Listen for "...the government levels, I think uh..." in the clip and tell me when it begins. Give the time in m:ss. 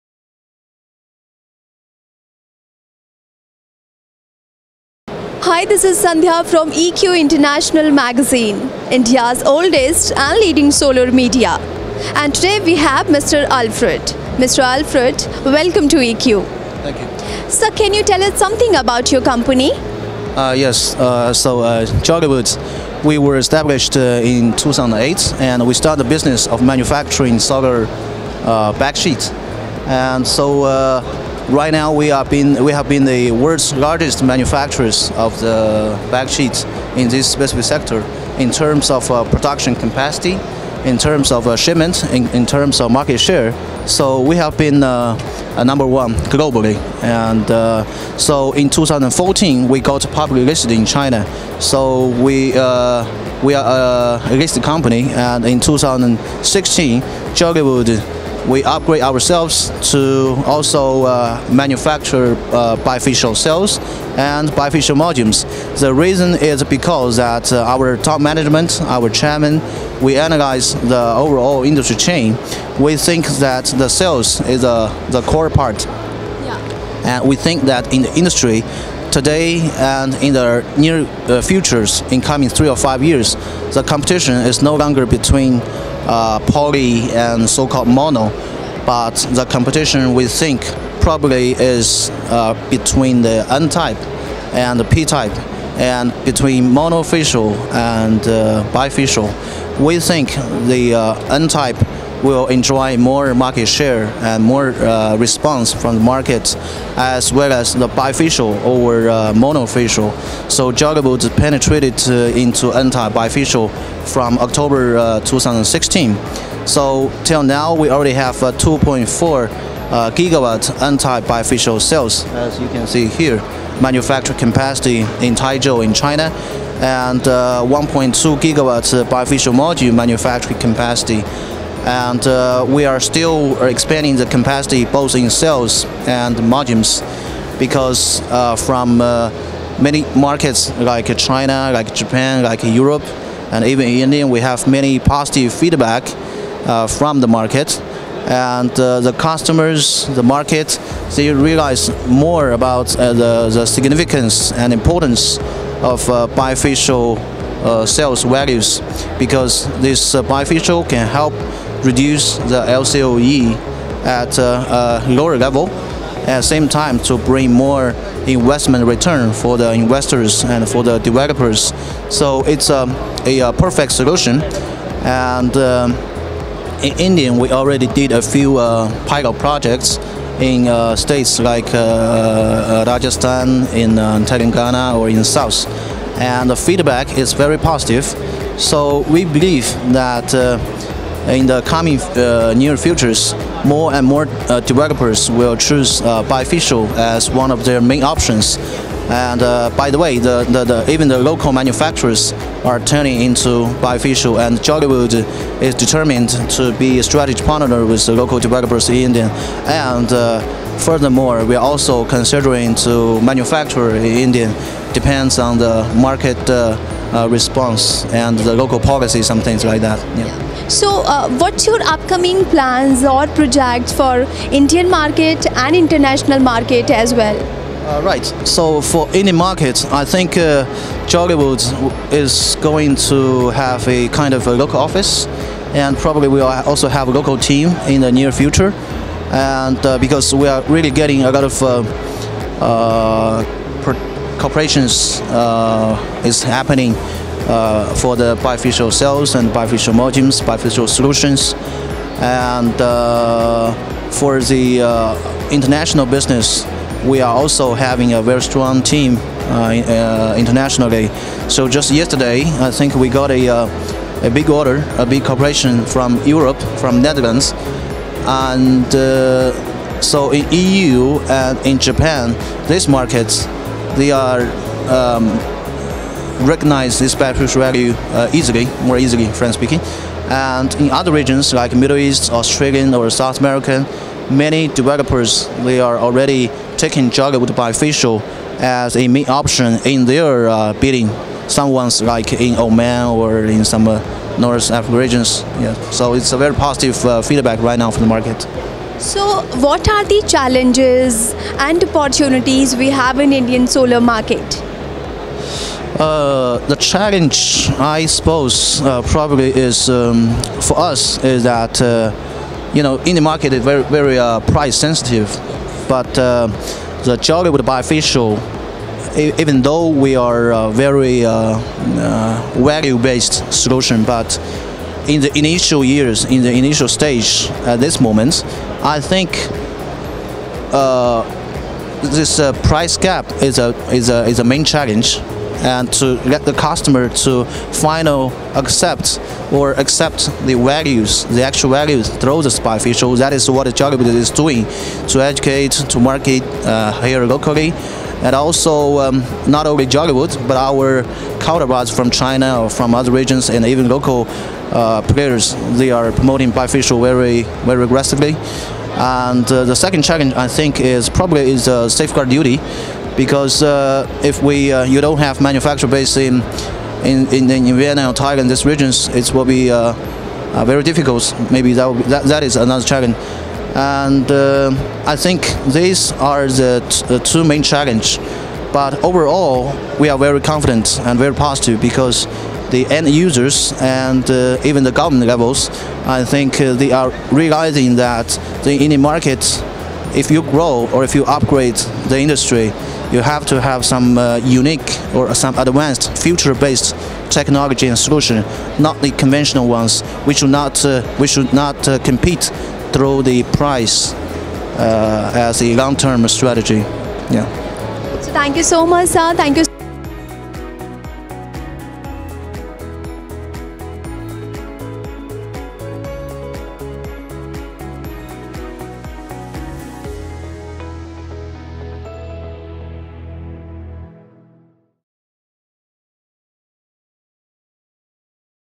6:24.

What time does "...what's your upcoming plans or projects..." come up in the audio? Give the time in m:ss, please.
3:41.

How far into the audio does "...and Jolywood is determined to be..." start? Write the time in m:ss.
3:24.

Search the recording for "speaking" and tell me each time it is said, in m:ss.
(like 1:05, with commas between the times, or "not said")
4:39.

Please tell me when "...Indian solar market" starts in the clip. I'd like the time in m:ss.
5:03.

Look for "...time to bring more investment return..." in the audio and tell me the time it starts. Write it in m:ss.
2:46.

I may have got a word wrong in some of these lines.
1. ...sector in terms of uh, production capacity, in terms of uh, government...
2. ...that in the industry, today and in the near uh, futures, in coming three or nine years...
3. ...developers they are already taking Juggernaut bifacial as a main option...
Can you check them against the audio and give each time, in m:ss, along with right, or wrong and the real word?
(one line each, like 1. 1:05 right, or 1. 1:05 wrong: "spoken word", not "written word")
1. 0:37 wrong: "shipment", not "government"
2. 1:17 wrong: "five", not "nine"
3. 4:44 right.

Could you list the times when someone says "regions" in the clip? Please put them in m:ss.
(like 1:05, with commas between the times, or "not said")
4:41, 4:54, 5:53, 6:08.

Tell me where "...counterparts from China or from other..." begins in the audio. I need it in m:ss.
5:51.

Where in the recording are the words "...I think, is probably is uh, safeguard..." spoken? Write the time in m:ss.
6:00.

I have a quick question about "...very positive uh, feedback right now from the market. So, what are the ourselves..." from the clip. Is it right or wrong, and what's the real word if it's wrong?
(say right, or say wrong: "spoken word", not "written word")
wrong: "challenges", not "ourselves".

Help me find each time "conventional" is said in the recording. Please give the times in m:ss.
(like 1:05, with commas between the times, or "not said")
6:39.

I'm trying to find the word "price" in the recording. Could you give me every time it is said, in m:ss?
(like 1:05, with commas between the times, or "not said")
5:14, 5:32, 6:43.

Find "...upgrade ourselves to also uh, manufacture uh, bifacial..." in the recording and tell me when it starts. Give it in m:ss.
0:58.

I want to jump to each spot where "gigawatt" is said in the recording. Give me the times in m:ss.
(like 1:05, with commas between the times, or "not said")
2:00, 2:08.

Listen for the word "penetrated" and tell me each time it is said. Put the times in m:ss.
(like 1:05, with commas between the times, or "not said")
1:51.